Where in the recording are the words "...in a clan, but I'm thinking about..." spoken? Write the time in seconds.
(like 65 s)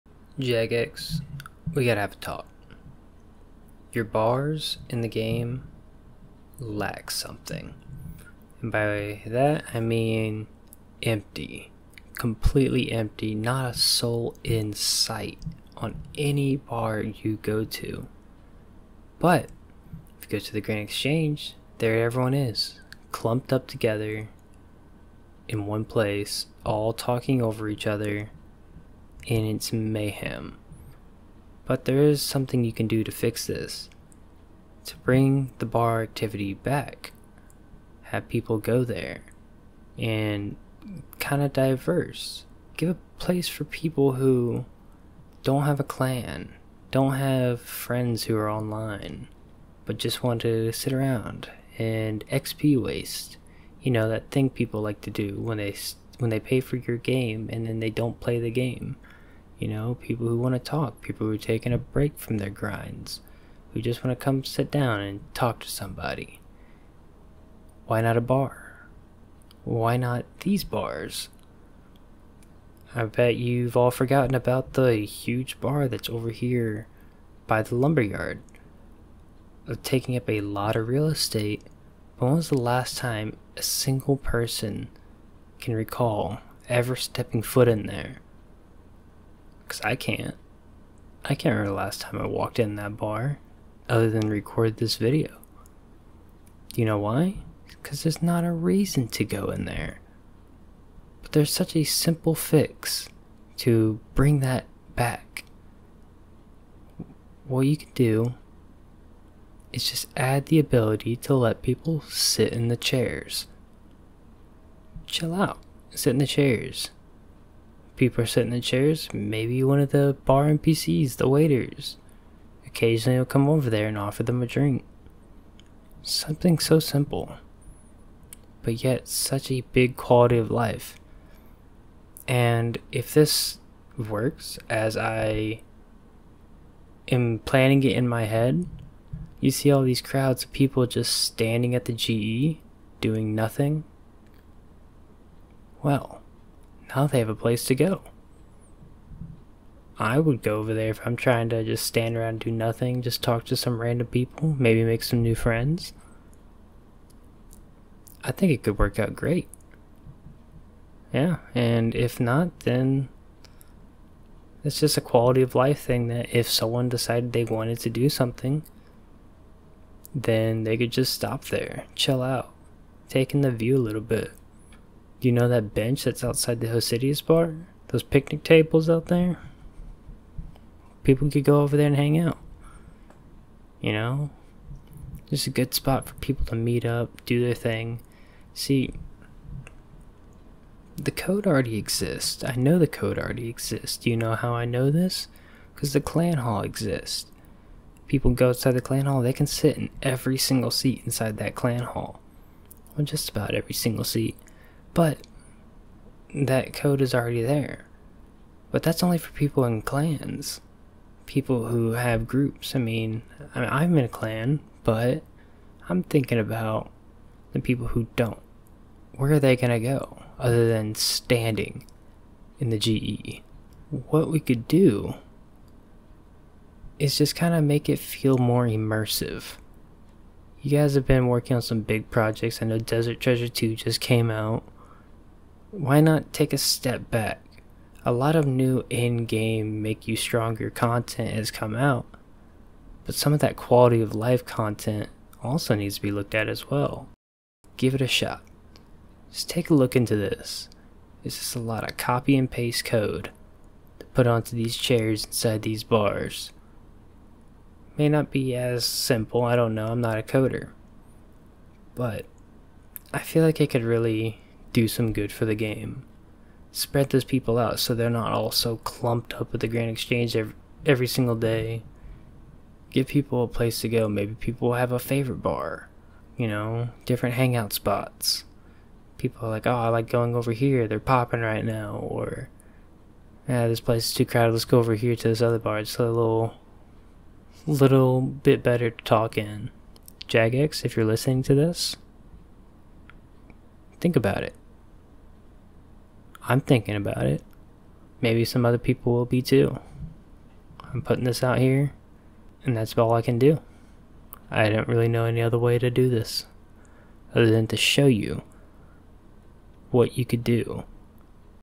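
213 s.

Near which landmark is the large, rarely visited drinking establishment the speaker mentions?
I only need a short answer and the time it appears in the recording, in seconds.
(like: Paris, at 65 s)
lumberyard, at 77 s.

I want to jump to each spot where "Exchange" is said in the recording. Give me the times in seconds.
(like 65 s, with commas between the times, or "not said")
20 s, 269 s.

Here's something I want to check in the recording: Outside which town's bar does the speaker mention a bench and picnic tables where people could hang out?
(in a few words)
Hosidius.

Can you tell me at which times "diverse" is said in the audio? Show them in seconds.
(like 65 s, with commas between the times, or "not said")
41 s.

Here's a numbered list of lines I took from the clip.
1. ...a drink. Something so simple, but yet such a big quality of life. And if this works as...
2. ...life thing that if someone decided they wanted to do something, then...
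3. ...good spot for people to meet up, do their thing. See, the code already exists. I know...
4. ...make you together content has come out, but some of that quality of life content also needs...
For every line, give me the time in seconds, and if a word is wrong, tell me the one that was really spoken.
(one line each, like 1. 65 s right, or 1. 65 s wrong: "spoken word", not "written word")
1. 124 s right
2. 165 s right
3. 185 s right
4. 239 s wrong: "stronger", not "together".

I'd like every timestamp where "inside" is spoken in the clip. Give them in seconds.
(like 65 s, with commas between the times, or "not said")
201 s, 255 s.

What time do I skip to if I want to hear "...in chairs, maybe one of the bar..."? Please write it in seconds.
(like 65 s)
118 s.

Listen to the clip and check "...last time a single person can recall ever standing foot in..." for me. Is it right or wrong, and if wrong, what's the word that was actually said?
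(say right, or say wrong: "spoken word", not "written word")
wrong: "stepping", not "standing".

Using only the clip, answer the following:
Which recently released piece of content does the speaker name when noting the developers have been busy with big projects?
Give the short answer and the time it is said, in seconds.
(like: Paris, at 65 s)
Desert Treasure 2, at 232 s.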